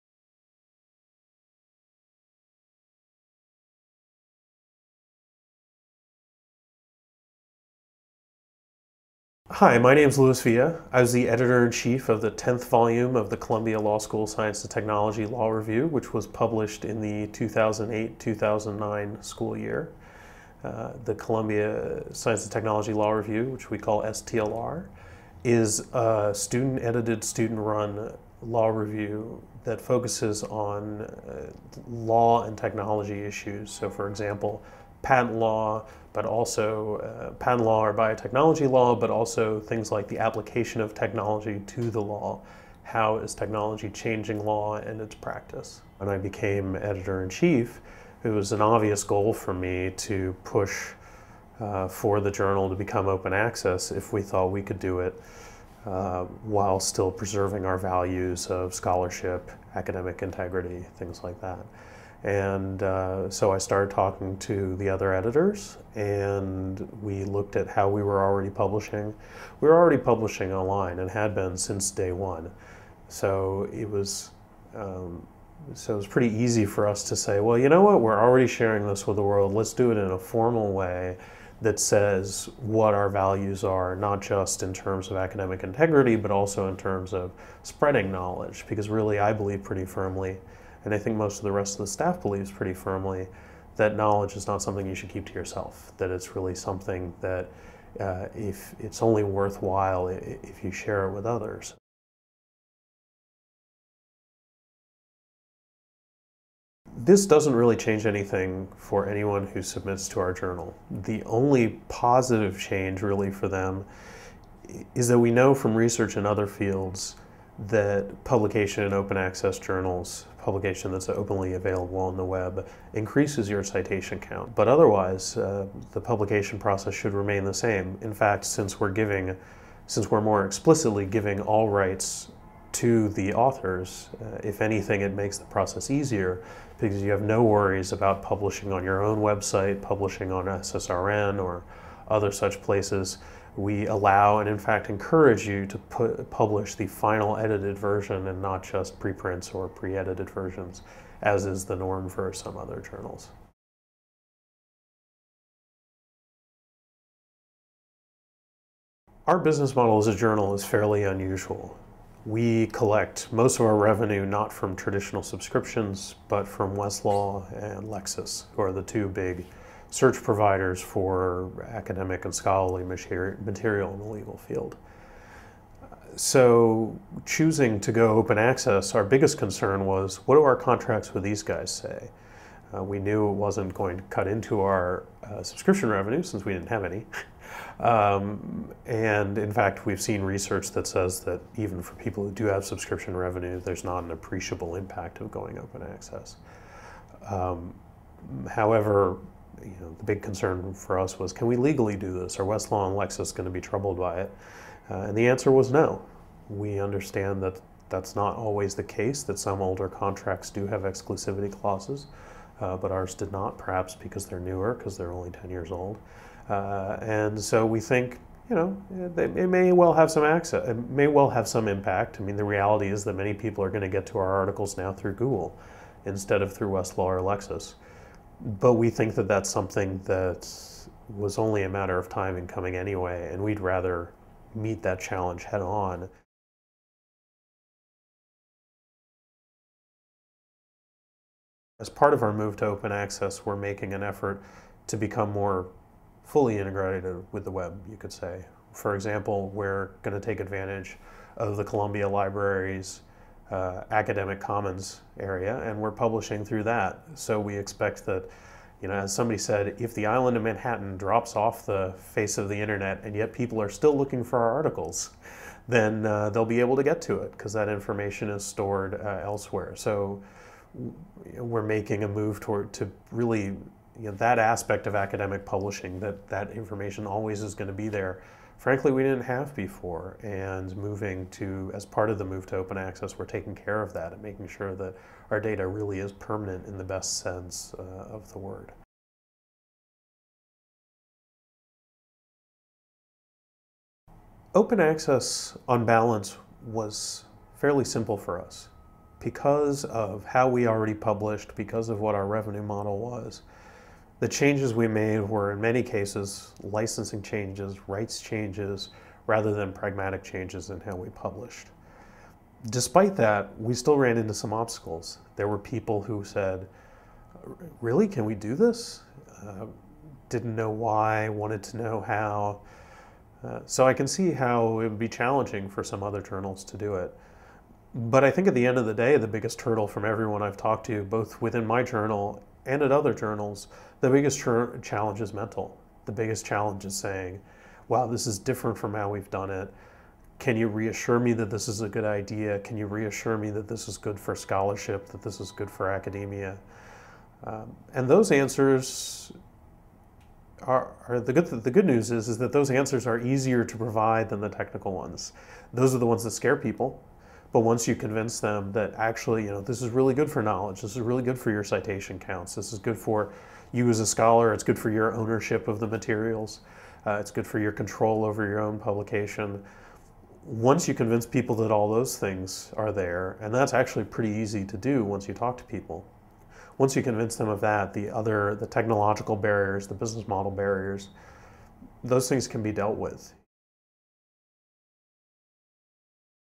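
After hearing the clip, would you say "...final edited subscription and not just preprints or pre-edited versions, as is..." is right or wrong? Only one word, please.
wrong.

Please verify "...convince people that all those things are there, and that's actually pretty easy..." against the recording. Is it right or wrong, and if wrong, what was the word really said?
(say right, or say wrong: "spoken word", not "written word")
right.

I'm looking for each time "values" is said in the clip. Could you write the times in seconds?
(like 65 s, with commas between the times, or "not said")
57 s, 83 s.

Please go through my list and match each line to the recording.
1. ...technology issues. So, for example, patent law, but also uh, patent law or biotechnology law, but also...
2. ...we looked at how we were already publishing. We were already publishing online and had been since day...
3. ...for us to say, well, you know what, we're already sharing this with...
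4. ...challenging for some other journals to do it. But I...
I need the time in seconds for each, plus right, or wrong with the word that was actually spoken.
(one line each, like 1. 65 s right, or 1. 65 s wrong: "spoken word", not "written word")
1. 32 s right
2. 67 s right
3. 76 s right
4. 325 s right.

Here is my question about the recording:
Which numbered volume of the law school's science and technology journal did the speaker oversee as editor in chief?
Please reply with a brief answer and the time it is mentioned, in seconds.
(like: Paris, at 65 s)
10th, at 12 s.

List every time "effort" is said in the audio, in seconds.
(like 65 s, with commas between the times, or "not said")
244 s.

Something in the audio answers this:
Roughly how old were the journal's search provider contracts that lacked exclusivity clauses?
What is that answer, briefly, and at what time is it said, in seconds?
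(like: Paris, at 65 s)
10 years, at 215 s.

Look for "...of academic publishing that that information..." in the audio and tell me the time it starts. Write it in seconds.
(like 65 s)
274 s.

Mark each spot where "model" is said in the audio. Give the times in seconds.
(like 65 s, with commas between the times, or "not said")
159 s, 302 s, 380 s.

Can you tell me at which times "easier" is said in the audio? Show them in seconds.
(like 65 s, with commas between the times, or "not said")
135 s, 353 s.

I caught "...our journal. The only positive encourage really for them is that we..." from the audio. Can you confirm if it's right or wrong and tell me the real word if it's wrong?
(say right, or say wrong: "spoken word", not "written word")
wrong: "change", not "encourage".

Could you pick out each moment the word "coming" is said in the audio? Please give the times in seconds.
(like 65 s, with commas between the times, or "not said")
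232 s.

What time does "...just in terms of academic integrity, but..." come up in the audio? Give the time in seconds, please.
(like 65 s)
84 s.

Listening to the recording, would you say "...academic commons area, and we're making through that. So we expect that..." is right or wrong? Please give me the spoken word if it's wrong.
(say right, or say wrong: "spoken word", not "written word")
wrong: "publishing", not "making".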